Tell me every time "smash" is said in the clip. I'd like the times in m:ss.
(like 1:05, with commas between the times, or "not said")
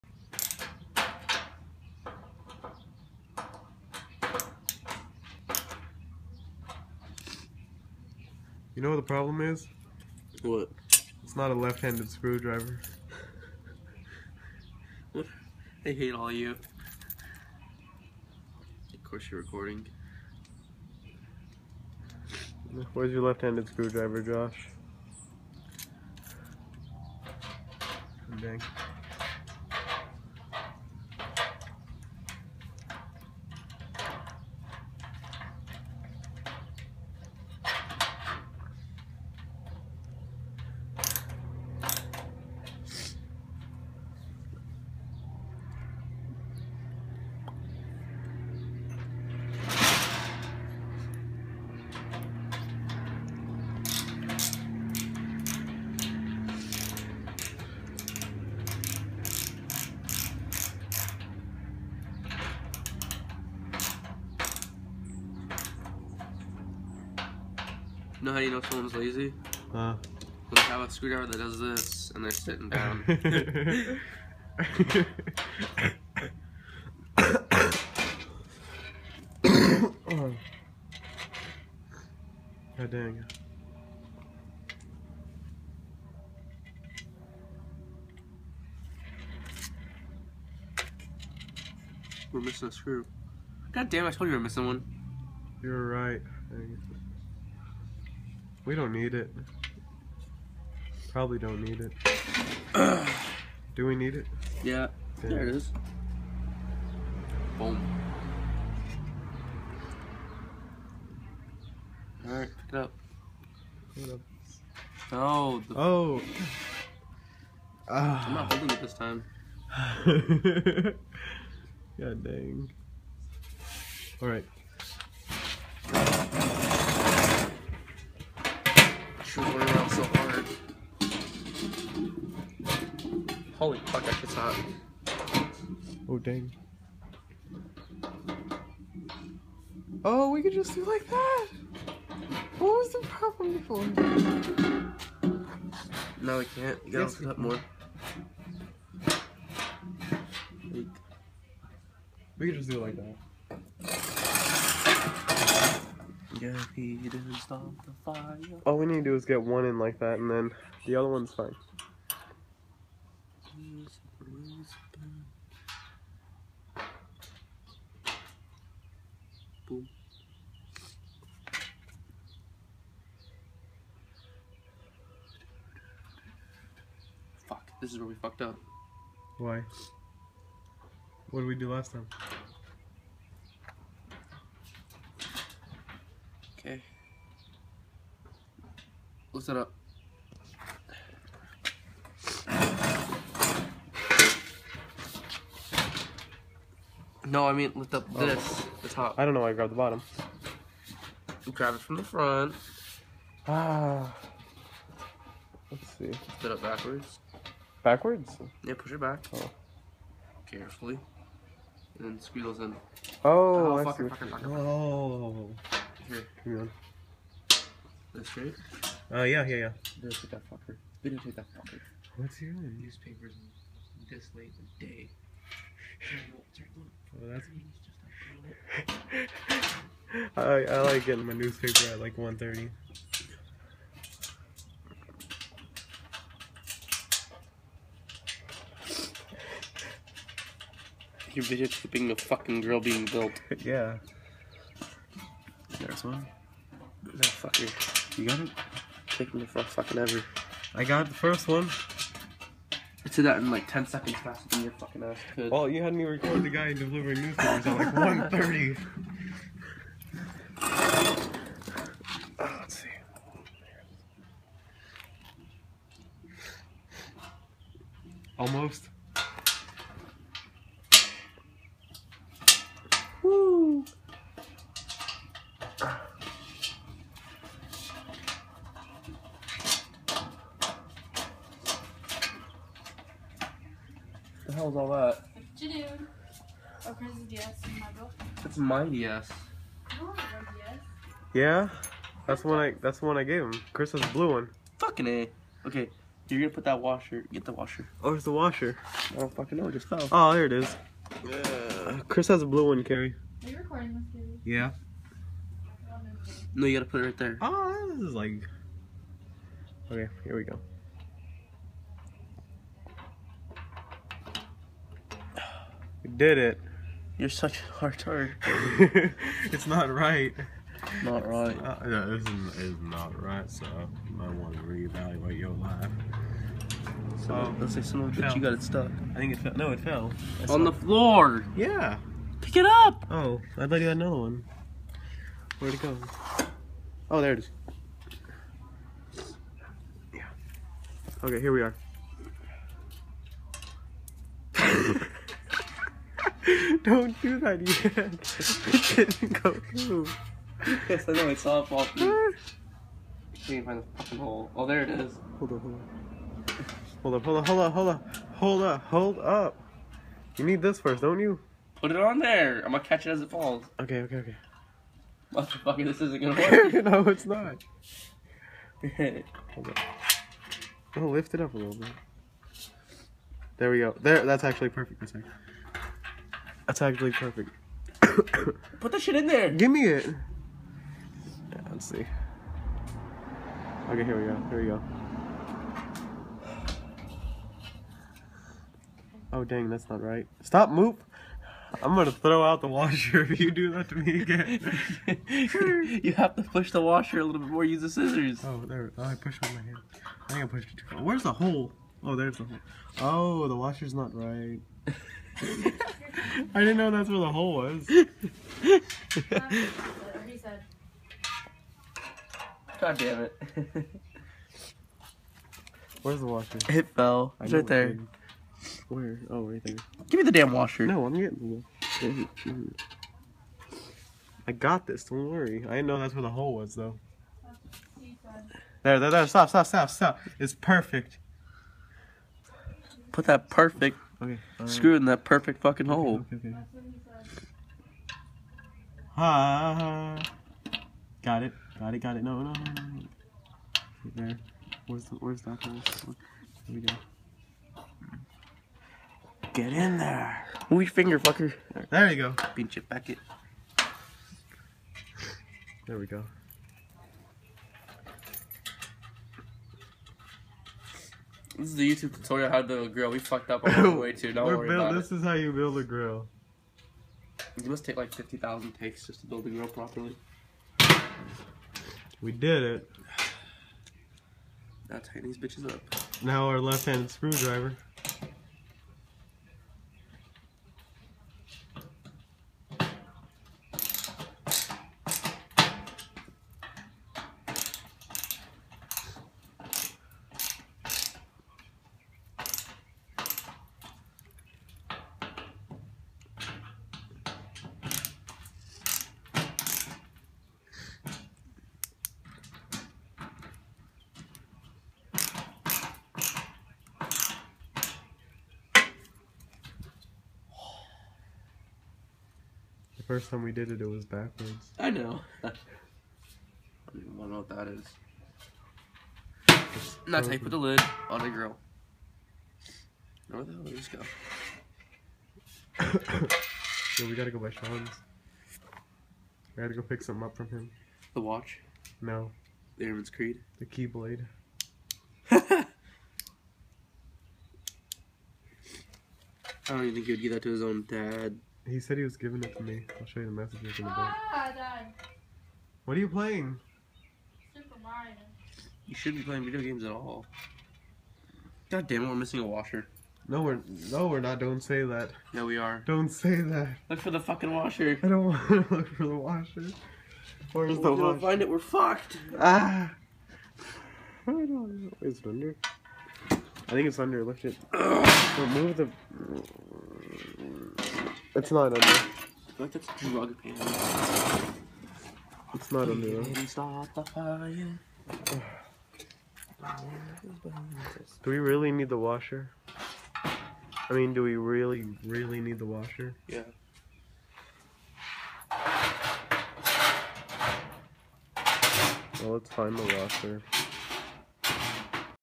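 not said.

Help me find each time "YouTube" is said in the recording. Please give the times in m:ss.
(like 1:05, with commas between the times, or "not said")
7:41.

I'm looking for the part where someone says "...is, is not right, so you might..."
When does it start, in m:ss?
5:22.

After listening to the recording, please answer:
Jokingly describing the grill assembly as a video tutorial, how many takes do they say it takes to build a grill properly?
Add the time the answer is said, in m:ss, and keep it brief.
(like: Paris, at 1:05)
50,000, at 7:47.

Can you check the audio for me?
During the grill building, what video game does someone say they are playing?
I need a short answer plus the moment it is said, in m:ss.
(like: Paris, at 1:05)
Super Mario, at 9:07.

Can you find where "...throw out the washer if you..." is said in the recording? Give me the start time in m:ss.
6:32.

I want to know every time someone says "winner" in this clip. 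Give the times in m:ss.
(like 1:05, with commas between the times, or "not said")
not said.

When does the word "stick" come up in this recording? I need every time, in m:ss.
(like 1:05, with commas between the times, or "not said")
not said.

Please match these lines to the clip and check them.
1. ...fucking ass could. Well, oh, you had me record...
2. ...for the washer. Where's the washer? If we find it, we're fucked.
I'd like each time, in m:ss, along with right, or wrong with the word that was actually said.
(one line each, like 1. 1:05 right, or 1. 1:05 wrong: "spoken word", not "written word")
1. 4:14 right
2. 9:18 right.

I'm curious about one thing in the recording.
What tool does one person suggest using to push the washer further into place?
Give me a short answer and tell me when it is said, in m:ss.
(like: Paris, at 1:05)
scissors, at 6:37.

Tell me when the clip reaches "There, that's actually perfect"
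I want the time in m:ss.
6:14.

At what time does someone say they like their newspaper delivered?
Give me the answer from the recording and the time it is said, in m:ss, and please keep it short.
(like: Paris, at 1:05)
1:30, at 3:51.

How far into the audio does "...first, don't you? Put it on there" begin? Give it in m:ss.
6:00.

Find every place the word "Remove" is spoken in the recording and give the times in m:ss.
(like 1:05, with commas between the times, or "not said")
9:27.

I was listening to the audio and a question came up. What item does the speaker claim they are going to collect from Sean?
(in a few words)
The Keyblade.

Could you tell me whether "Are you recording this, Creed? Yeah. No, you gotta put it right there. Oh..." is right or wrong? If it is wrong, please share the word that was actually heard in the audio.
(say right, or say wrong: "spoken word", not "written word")
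wrong: "Carrie", not "Creed".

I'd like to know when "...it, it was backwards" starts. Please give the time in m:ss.
8:33.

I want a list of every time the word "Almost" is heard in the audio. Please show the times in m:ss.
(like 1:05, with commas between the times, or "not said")
4:28.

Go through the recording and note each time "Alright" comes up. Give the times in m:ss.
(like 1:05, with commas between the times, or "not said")
1:52, 2:04.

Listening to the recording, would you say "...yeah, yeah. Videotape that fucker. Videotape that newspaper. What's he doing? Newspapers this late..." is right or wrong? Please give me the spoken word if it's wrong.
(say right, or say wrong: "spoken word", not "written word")
wrong: "fucker", not "newspaper".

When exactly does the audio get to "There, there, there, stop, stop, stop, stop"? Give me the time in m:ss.
7:08.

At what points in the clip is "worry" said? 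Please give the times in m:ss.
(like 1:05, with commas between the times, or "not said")
7:05, 7:44.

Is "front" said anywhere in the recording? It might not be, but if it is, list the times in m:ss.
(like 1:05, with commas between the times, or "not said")
3:22.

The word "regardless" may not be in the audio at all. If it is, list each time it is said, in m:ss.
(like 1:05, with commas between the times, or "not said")
not said.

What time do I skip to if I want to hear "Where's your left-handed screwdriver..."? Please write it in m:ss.
0:22.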